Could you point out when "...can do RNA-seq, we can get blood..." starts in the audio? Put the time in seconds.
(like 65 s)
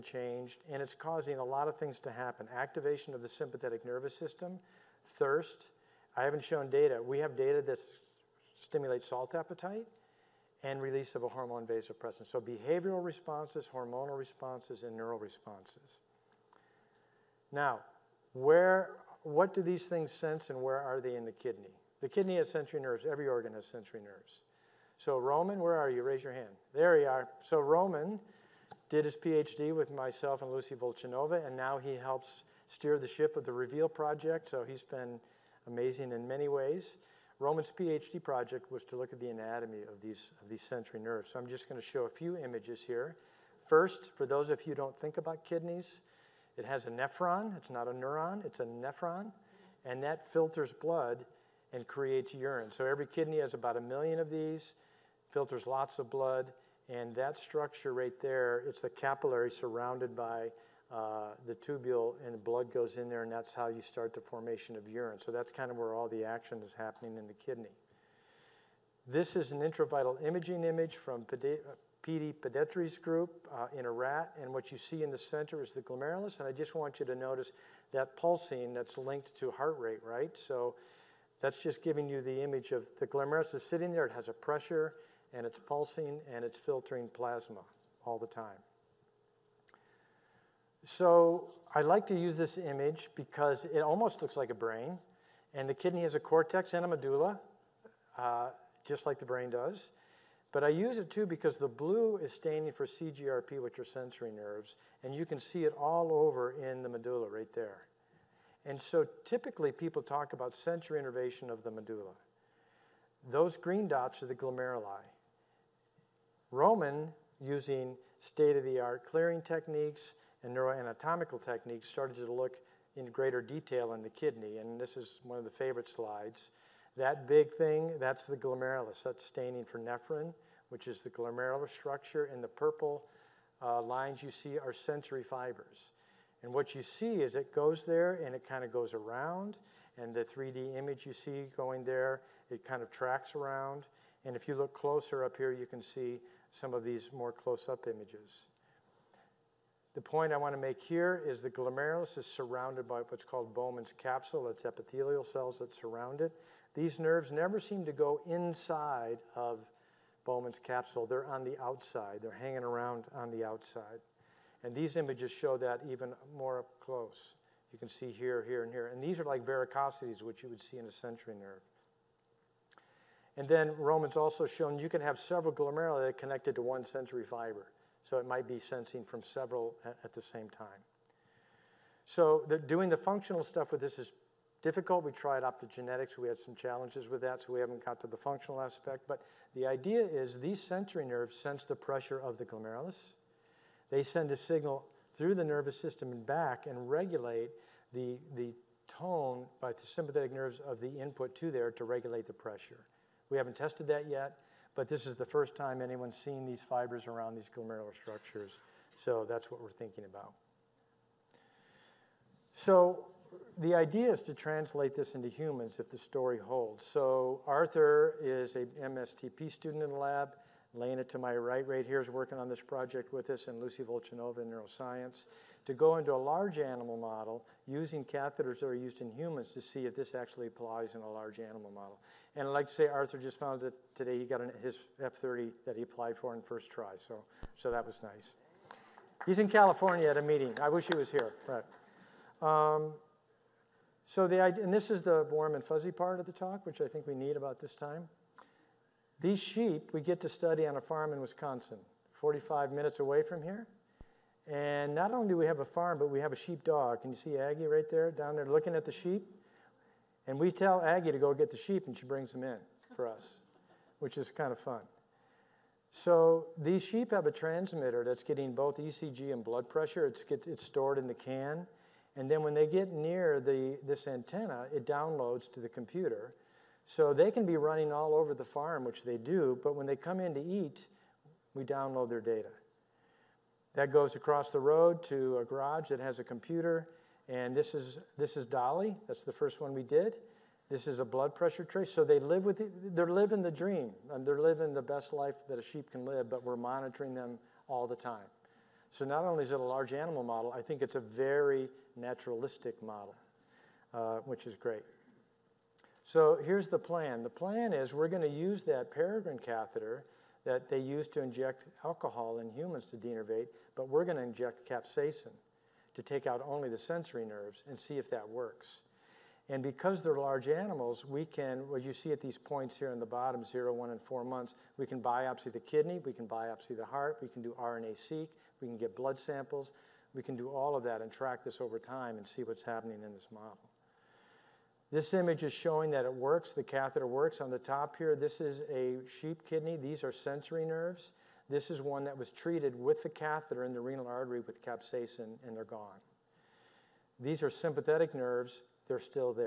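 327 s.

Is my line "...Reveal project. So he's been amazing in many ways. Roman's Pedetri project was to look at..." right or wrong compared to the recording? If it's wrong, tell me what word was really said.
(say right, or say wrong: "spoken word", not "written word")
wrong: "PhD", not "Pedetri".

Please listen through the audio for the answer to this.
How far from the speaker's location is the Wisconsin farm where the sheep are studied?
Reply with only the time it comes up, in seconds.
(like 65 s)
252 s.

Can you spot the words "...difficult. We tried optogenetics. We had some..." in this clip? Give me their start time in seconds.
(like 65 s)
184 s.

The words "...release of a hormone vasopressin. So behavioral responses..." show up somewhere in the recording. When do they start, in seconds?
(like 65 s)
10 s.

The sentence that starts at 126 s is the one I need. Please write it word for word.
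That big thing, that's the glomerulus.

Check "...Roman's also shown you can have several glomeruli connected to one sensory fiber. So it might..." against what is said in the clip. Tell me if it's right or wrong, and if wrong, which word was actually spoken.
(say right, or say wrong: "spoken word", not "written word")
right.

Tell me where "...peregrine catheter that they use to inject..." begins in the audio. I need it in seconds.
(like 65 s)
308 s.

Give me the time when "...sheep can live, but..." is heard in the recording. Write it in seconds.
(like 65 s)
295 s.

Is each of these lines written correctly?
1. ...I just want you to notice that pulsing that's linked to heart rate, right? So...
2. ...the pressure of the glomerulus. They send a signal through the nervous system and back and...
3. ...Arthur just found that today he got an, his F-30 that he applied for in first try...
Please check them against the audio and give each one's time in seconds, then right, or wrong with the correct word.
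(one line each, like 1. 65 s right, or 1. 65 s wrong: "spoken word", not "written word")
1. 76 s right
2. 191 s right
3. 232 s right.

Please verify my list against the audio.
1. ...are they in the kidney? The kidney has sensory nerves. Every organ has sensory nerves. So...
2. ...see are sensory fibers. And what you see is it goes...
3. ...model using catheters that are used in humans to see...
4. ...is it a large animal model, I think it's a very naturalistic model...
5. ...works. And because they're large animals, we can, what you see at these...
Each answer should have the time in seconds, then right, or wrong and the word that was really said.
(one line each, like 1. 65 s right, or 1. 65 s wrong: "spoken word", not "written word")
1. 20 s right
2. 134 s right
3. 226 s right
4. 299 s right
5. 318 s right.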